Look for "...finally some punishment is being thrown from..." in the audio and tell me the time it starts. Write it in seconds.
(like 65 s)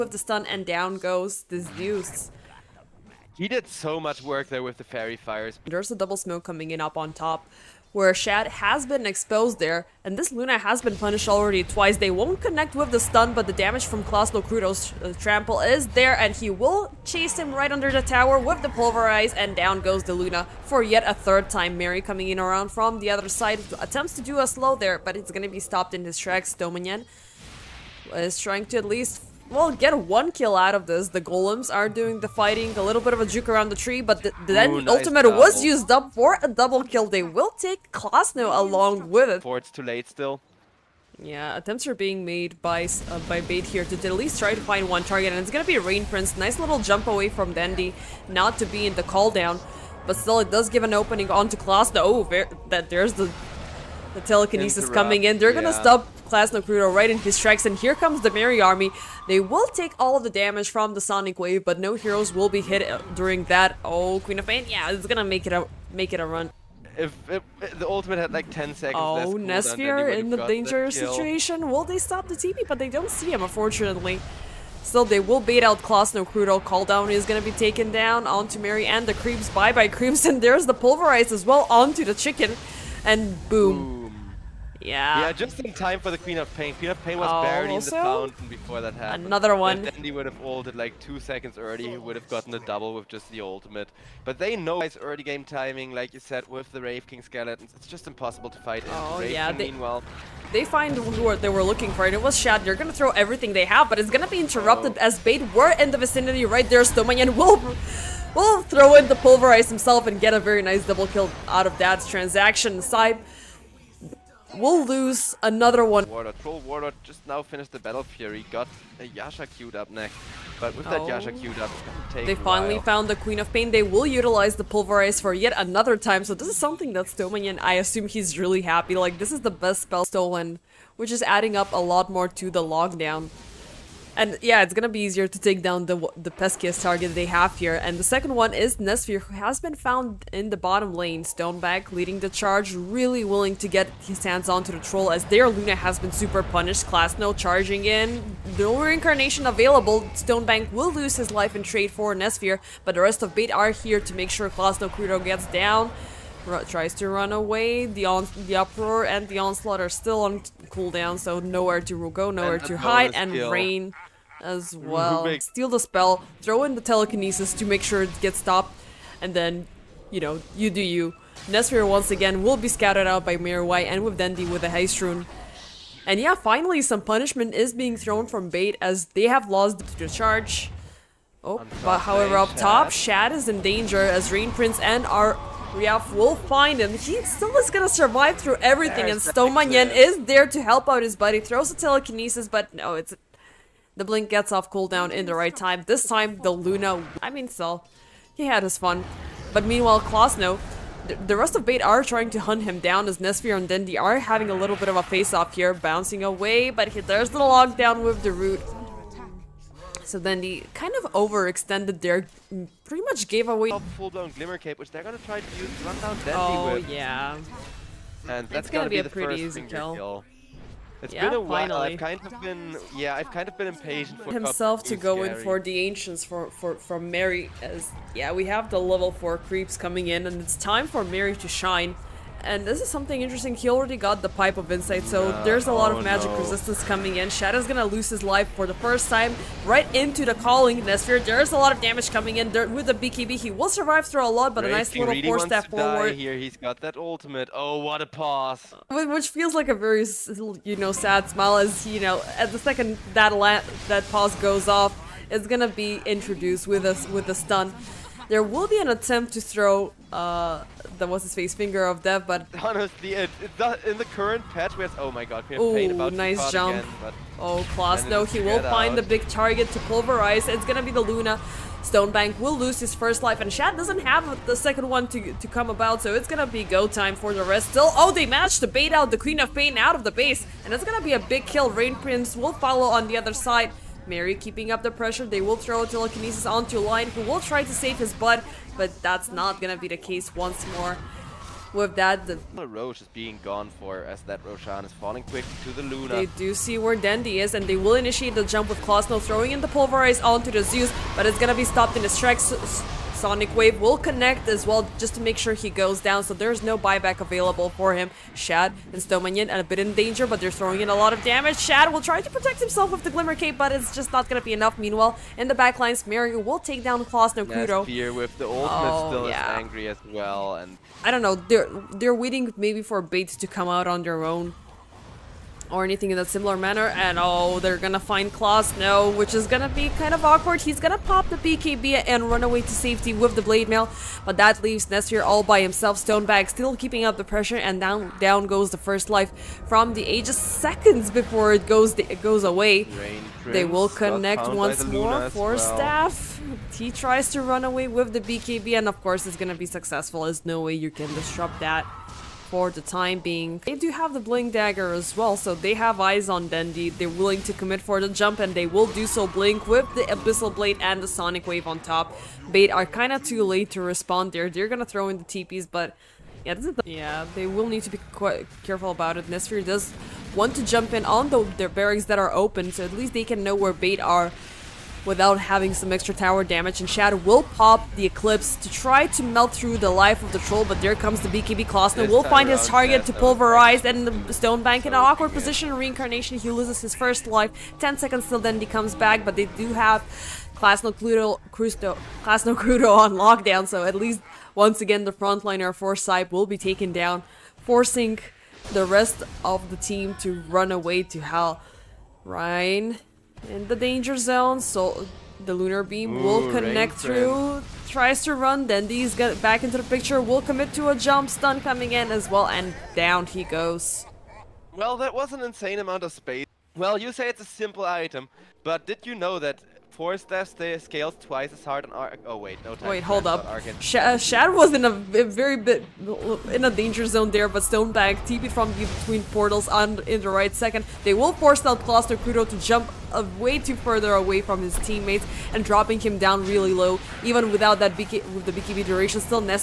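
176 s.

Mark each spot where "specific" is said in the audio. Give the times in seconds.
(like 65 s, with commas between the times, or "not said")
not said.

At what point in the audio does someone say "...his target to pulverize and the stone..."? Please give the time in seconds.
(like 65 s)
382 s.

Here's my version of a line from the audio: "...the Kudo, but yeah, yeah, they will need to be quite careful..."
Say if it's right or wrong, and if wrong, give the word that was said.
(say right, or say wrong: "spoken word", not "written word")
wrong: "TPs", not "Kudo".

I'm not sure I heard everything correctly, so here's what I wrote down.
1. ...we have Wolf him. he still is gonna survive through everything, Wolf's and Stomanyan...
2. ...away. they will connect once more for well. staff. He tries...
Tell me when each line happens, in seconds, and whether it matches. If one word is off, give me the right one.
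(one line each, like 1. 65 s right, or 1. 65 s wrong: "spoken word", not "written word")
1. 185 s wrong: "There", not "Wolf"
2. 342 s right.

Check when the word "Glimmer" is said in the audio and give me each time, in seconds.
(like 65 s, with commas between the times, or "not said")
214 s, 313 s.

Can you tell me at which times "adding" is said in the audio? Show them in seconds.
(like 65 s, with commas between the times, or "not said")
131 s.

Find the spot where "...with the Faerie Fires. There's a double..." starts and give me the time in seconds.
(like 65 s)
4 s.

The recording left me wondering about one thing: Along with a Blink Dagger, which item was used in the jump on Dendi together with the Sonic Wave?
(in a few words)
Abyssal Blade.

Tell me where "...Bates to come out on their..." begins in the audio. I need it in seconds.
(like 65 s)
323 s.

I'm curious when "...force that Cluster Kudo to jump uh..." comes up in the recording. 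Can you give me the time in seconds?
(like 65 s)
431 s.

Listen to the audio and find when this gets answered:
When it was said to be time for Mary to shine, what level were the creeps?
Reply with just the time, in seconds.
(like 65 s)
228 s.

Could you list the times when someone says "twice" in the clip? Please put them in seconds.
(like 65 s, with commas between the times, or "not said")
11 s, 421 s.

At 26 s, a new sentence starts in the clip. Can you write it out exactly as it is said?
Dominion is trying to at least well, get one kill out of this.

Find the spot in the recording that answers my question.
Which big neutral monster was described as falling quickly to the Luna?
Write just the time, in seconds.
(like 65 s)
294 s.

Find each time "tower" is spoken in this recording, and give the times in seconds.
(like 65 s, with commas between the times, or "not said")
18 s, 376 s.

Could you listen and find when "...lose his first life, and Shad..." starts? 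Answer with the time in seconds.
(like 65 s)
272 s.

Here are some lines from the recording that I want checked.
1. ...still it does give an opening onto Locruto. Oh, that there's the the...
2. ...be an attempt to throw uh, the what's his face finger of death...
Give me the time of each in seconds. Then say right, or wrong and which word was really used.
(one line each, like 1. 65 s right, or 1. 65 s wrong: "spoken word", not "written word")
1. 50 s wrong: "Klasno", not "Locruto"
2. 258 s right.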